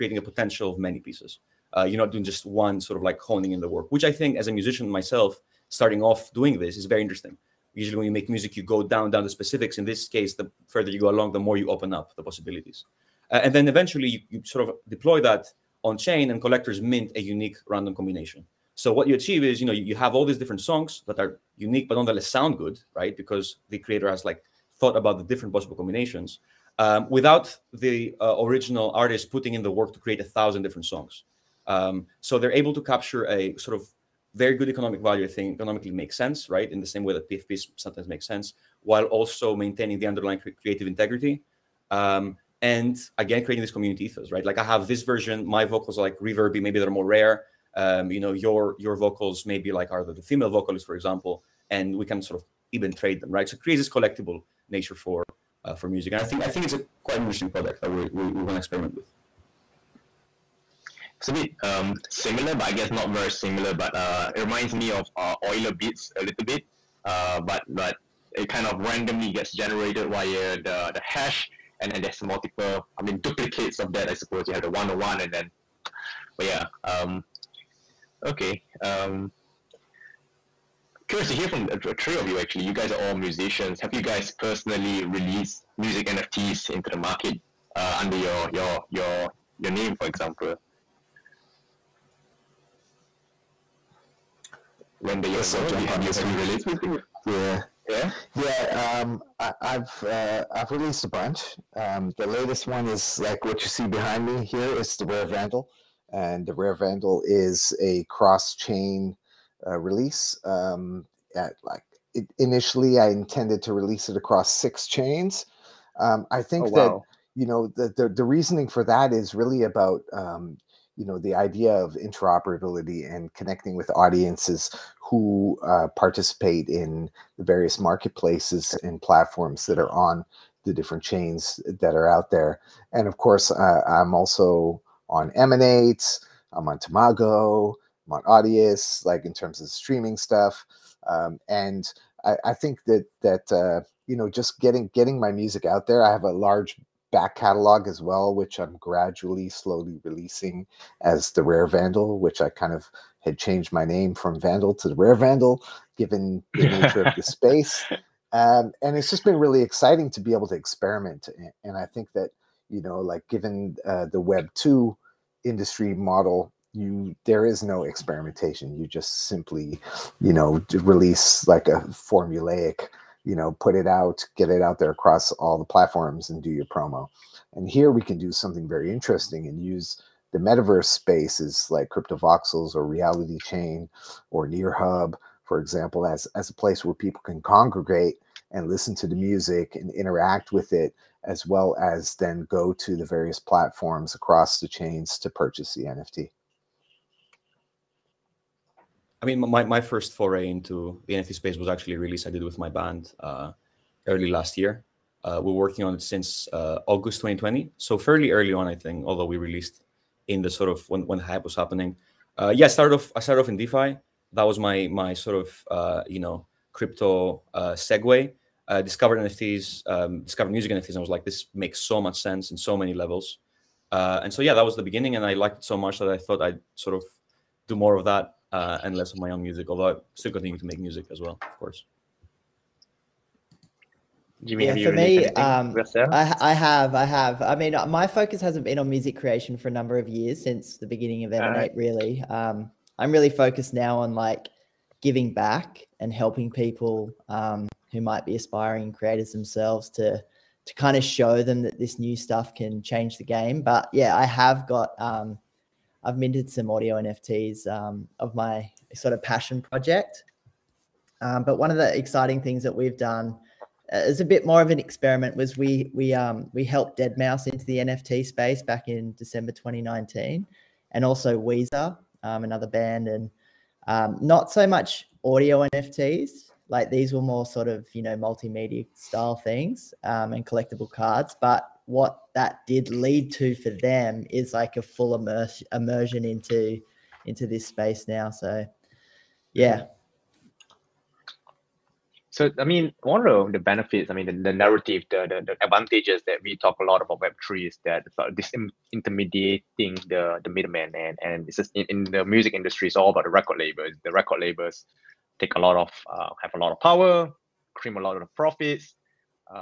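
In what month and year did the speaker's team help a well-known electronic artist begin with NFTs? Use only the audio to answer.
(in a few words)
December 2019.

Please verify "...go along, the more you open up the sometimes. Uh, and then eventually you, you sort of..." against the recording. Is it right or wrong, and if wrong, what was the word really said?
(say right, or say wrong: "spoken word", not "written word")
wrong: "possibilities", not "sometimes".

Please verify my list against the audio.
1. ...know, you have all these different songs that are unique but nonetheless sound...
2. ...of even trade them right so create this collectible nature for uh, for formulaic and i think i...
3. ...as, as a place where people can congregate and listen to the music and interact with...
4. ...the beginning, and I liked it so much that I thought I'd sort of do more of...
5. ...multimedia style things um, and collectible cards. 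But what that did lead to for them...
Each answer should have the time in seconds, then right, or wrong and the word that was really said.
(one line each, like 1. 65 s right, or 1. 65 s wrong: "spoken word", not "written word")
1. 19 s right
2. 52 s wrong: "music", not "formulaic"
3. 186 s right
4. 224 s right
5. 278 s right.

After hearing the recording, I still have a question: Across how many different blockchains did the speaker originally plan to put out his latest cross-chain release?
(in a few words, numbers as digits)
6.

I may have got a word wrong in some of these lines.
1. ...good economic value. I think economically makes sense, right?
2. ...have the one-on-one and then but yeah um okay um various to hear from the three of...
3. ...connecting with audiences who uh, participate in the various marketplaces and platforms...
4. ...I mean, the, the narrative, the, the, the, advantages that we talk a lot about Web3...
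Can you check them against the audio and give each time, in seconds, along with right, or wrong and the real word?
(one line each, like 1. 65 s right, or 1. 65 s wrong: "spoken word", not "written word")
1. 34 s right
2. 74 s wrong: "curious", not "various"
3. 123 s right
4. 294 s right.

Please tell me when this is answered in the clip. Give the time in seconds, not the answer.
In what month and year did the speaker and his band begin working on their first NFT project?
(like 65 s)
206 s.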